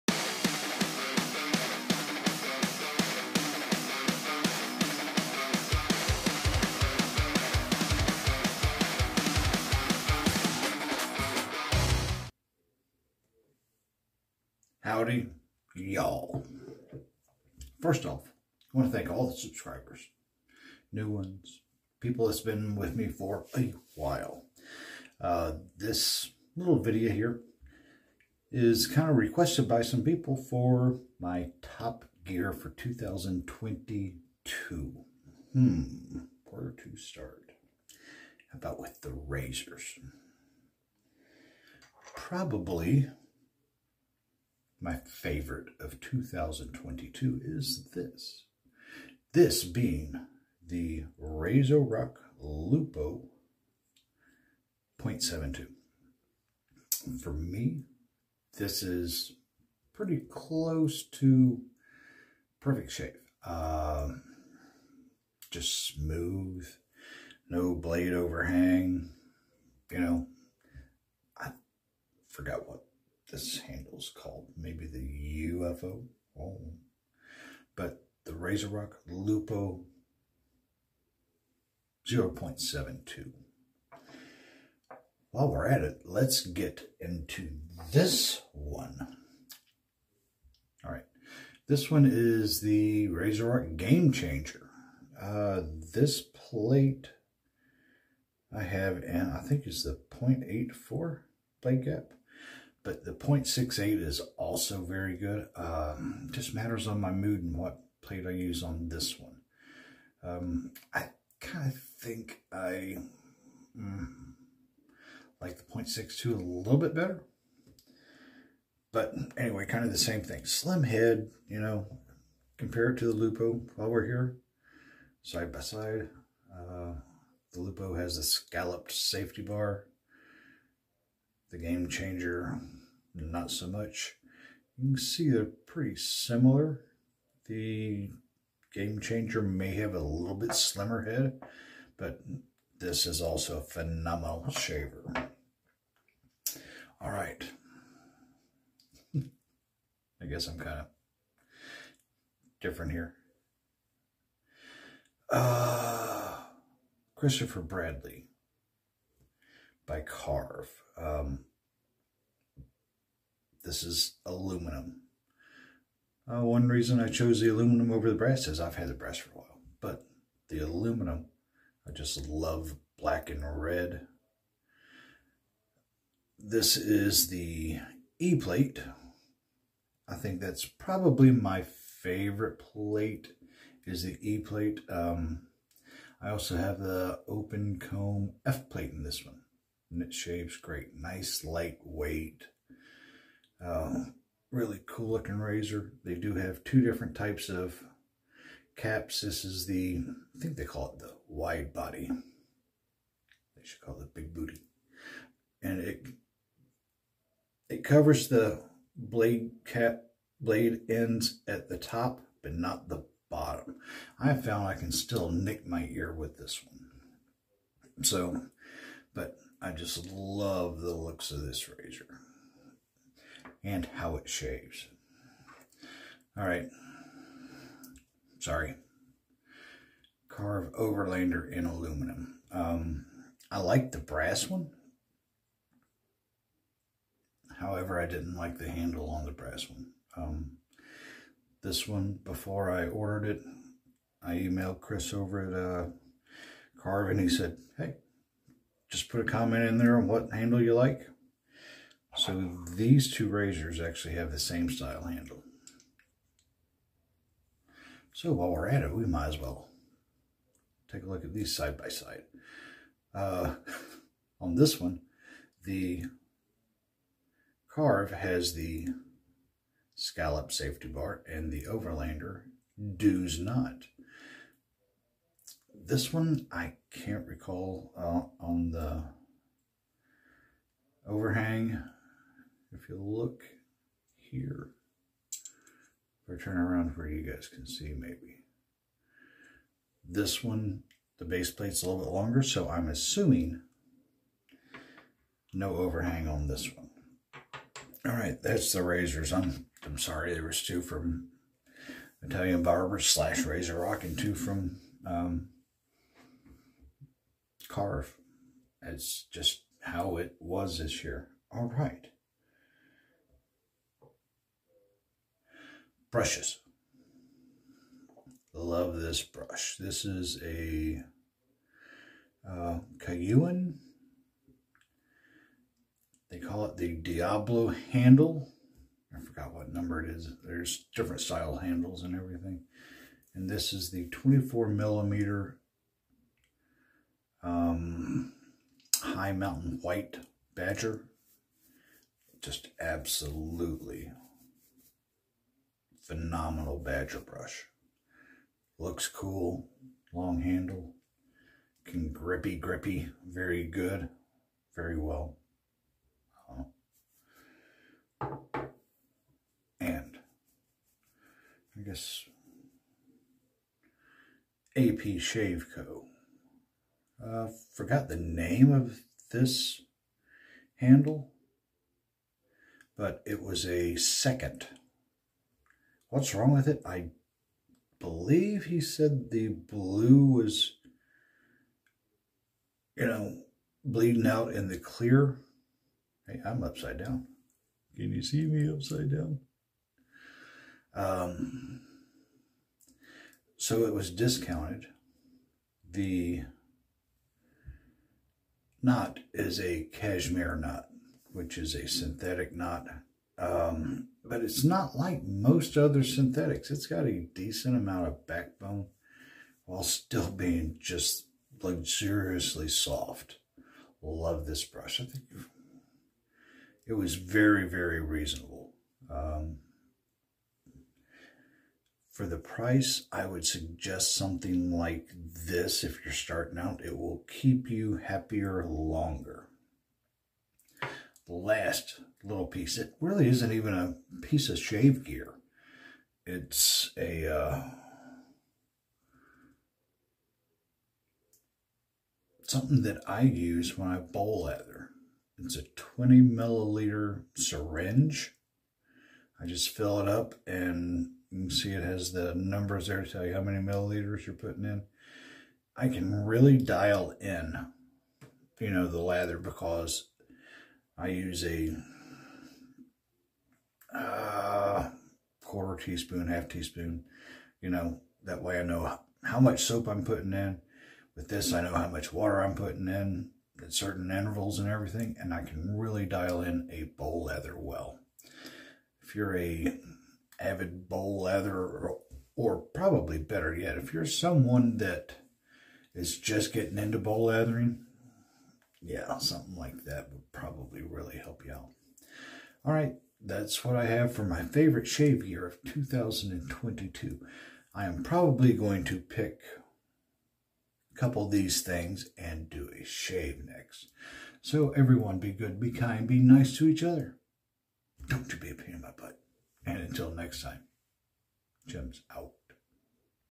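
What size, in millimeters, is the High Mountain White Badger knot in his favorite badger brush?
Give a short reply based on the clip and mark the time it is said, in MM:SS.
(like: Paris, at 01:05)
24 millimeters, at 05:34.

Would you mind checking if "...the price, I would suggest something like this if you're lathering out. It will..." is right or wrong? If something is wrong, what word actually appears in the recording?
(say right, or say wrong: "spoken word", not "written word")
wrong: "starting", not "lathering".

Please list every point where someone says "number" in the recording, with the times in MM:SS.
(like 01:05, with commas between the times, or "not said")
05:29, 07:32.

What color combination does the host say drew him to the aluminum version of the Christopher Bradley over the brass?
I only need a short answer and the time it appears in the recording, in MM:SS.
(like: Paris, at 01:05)
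Black and red, at 02:52.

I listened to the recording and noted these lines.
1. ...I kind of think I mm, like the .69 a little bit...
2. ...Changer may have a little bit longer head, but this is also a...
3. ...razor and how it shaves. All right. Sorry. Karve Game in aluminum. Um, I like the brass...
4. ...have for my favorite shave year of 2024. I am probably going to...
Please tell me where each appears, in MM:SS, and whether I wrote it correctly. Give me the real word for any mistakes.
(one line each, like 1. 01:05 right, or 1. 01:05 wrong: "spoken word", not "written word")
1. 01:50 wrong: "62", not "69"
2. 02:19 wrong: "slimmer", not "longer"
3. 03:41 wrong: "Overlander", not "Game"
4. 08:13 wrong: "2022", not "2024".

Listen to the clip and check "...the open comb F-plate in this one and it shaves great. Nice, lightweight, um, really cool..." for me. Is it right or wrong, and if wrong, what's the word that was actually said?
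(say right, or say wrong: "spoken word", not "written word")
right.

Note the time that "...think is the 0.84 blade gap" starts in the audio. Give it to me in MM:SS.
01:39.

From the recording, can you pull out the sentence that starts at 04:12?
So these two razors actually have the same style handle.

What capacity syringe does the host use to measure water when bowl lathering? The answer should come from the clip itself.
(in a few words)
20 milliliters.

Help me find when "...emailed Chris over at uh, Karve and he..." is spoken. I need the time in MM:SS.
04:04.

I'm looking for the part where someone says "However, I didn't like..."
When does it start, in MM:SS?
03:57.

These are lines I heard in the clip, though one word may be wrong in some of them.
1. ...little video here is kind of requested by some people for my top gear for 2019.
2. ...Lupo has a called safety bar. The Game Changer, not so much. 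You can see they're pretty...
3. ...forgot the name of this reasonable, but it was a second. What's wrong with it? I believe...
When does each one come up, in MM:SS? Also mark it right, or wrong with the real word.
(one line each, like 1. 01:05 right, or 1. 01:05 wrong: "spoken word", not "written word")
1. 00:26 wrong: "2022", not "2019"
2. 02:07 wrong: "scalloped", not "called"
3. 06:07 wrong: "handle", not "reasonable".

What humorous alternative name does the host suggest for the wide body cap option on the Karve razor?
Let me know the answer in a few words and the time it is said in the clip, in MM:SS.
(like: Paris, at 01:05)
Big booty, at 03:24.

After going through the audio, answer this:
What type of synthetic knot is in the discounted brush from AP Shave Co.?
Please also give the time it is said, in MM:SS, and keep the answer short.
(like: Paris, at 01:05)
Cashmere, at 06:39.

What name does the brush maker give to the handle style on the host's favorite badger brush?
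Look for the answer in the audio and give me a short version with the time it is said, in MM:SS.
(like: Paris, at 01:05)
Diablo, at 05:26.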